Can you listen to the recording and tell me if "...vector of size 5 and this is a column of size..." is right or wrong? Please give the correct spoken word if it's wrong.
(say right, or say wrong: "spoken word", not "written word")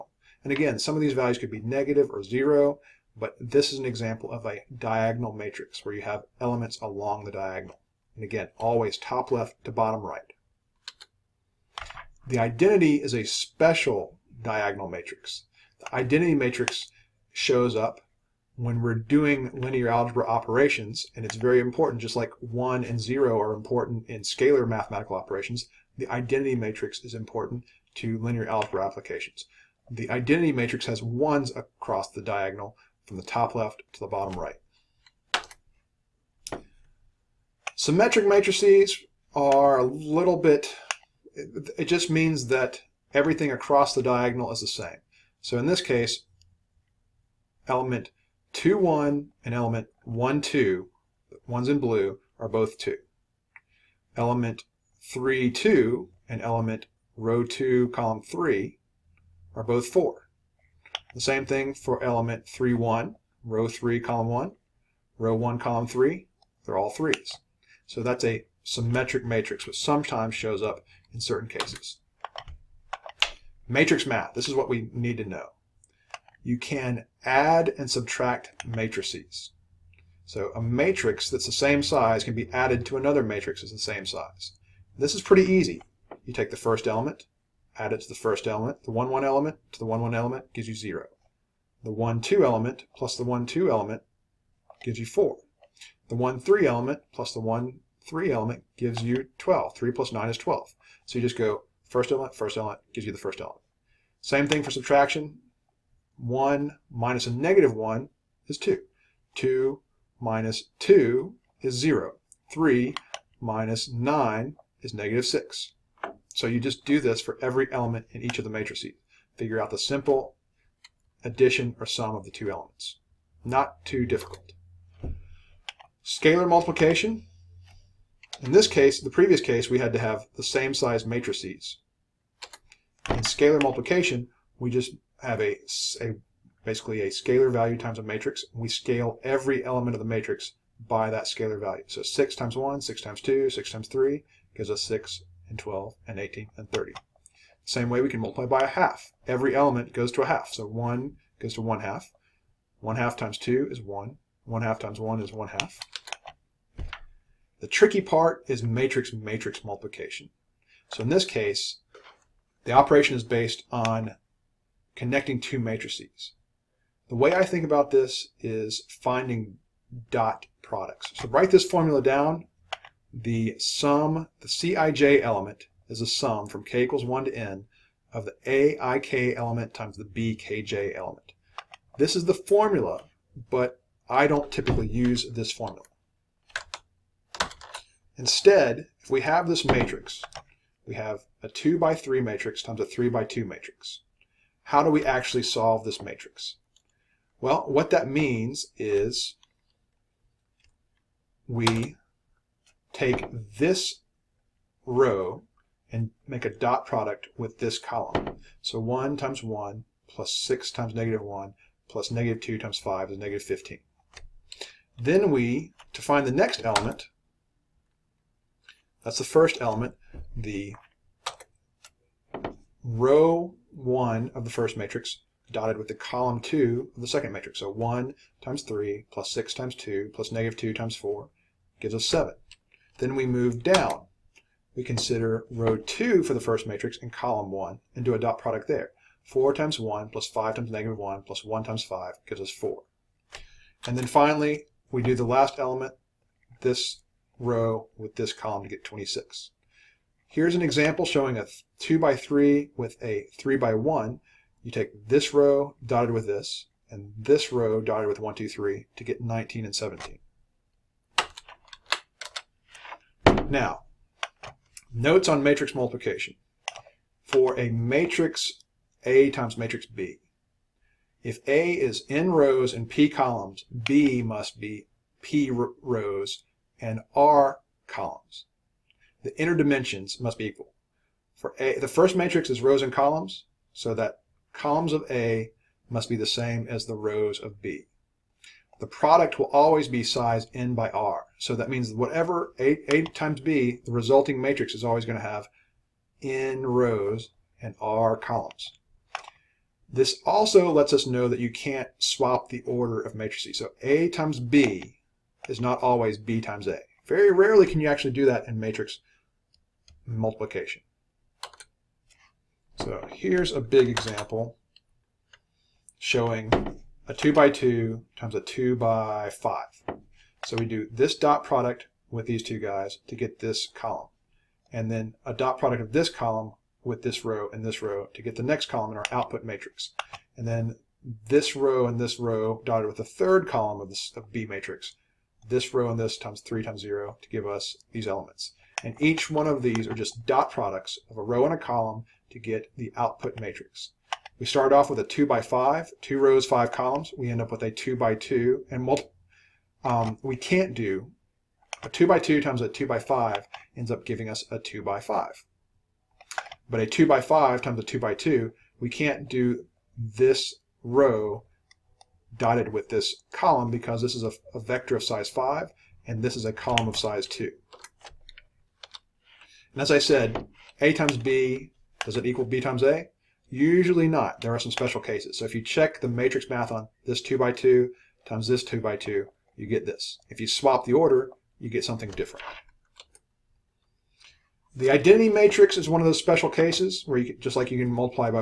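right.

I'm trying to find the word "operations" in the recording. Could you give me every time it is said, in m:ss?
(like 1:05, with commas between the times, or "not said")
0:20, 0:25, 2:42.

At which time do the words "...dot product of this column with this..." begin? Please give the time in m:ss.
5:25.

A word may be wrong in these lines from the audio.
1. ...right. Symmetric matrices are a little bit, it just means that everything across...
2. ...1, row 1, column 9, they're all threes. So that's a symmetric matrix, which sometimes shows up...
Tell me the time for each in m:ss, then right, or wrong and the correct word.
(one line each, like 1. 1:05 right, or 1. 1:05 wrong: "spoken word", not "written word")
1. 0:34 right
2. 1:04 wrong: "3", not "9".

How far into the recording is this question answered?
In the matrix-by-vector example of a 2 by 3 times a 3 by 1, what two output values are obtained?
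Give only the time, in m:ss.
4:19.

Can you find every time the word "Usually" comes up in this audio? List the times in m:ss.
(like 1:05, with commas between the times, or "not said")
6:13.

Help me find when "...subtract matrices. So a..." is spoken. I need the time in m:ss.
1:17.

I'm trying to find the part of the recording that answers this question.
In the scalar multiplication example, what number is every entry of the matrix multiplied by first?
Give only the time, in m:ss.
2:22.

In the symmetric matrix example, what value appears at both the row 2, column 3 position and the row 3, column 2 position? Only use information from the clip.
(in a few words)
4.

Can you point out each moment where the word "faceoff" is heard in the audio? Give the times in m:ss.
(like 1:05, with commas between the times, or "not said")
not said.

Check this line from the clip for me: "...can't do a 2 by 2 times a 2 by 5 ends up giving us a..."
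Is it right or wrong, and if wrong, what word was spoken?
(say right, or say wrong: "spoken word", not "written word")
right.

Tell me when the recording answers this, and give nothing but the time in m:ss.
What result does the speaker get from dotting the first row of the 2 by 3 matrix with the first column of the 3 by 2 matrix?
3:33.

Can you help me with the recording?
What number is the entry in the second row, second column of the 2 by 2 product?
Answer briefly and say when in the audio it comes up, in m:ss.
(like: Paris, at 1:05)
26, at 4:08.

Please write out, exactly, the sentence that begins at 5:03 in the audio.
So a times b is not always b times a.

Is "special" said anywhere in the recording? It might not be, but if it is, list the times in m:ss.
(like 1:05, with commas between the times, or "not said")
0:13, 6:14, 6:26.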